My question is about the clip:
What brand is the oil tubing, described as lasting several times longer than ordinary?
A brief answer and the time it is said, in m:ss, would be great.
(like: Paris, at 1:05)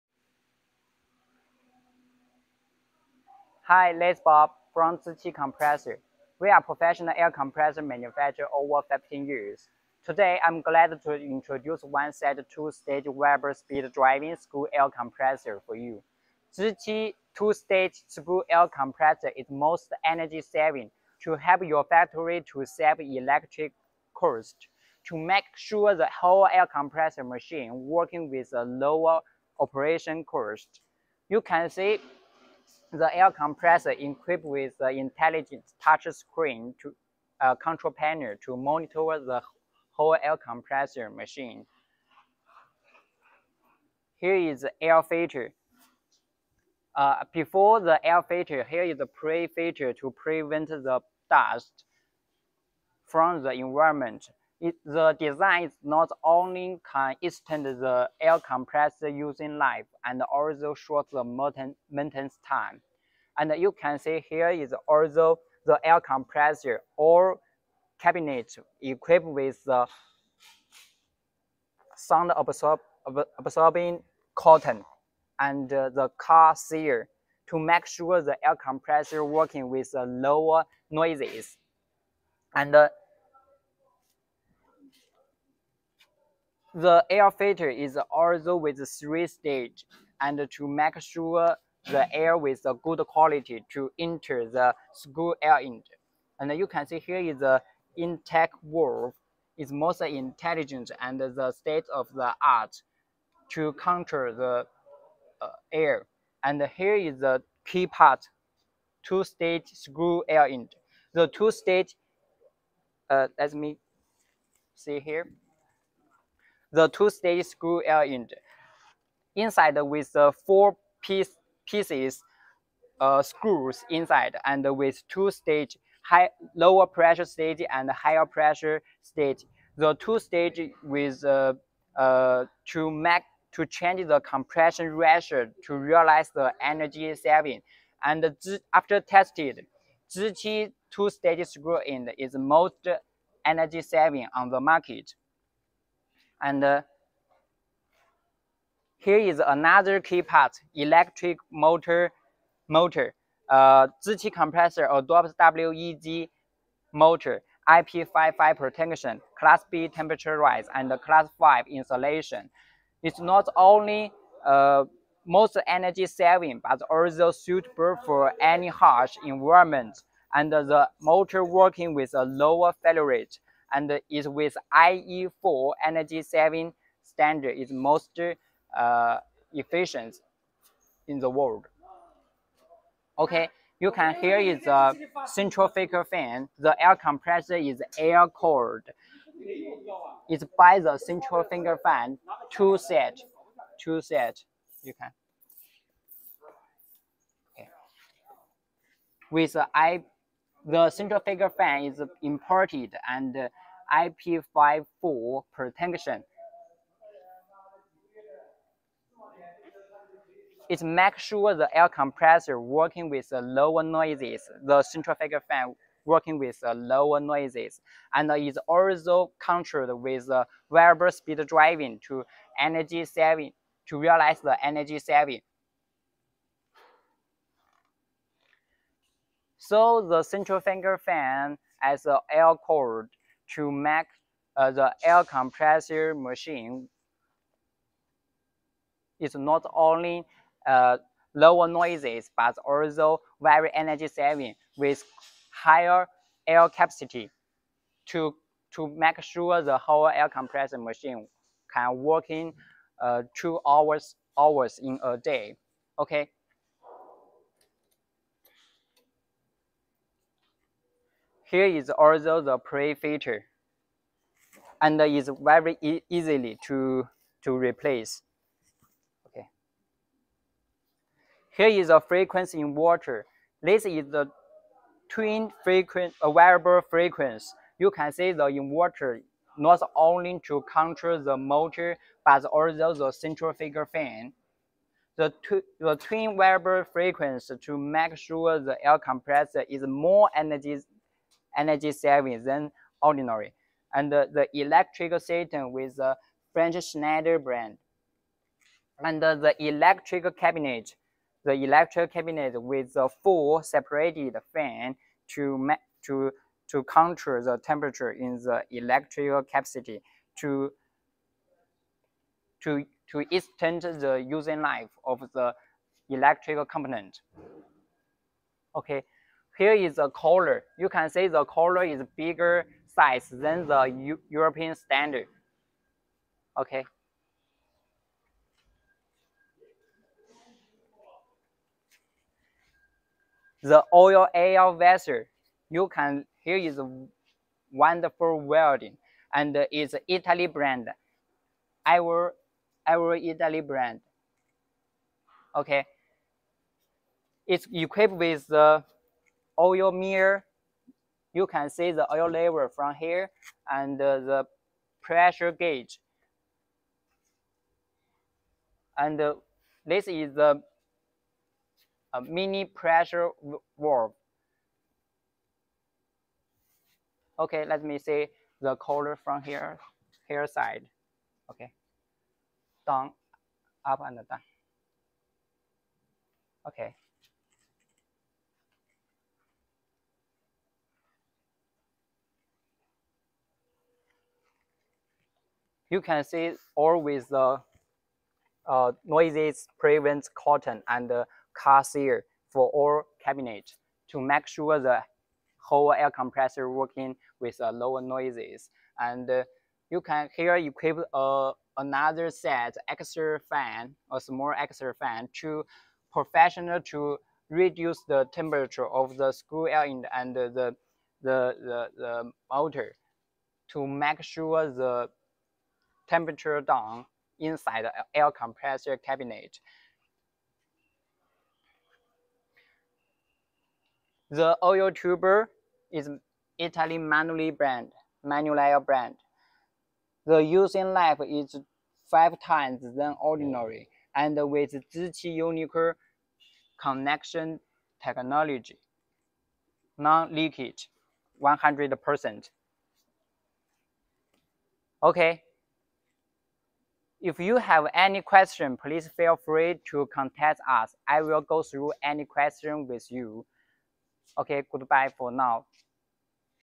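Manuli, at 7:06.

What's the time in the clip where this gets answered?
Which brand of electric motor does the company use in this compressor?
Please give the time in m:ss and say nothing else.
2:35.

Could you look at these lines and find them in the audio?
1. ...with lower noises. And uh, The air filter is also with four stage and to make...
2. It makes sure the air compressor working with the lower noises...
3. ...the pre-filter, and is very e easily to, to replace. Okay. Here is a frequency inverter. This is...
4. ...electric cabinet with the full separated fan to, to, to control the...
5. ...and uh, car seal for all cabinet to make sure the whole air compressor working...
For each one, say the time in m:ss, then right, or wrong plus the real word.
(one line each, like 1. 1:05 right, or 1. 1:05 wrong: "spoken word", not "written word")
1. 1:19 wrong: "three", not "four"
2. 3:30 right
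3. 4:22 right
4. 5:01 right
5. 6:30 right.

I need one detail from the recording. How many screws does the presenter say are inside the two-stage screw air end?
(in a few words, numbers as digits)
4.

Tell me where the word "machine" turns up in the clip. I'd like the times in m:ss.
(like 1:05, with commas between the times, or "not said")
0:27, 0:41, 3:56, 4:10.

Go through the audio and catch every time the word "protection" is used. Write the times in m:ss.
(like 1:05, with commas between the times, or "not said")
2:38, 3:25.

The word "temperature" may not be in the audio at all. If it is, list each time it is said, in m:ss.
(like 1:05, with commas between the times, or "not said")
2:39, 5:07, 6:48, 6:56.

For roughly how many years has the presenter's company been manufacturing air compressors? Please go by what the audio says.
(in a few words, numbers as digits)
15 years.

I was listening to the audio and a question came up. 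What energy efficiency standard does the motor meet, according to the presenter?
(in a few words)
IE4.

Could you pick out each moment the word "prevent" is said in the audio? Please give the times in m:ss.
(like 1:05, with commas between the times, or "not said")
0:50, 6:29.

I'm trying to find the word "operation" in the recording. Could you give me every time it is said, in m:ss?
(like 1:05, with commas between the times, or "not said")
0:29.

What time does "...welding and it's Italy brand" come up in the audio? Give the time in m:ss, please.
5:38.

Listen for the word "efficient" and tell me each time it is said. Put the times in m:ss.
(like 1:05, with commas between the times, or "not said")
2:59.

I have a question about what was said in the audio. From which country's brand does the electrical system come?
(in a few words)
French Schneider.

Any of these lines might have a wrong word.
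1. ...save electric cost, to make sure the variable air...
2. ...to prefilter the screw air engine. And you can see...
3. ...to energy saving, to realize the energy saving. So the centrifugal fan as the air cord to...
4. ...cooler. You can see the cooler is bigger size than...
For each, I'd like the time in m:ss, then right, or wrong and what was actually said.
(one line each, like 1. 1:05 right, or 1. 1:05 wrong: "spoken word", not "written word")
1. 0:22 wrong: "whole", not "variable"
2. 1:33 wrong: "enter", not "prefilter"
3. 3:42 right
4. 5:20 right.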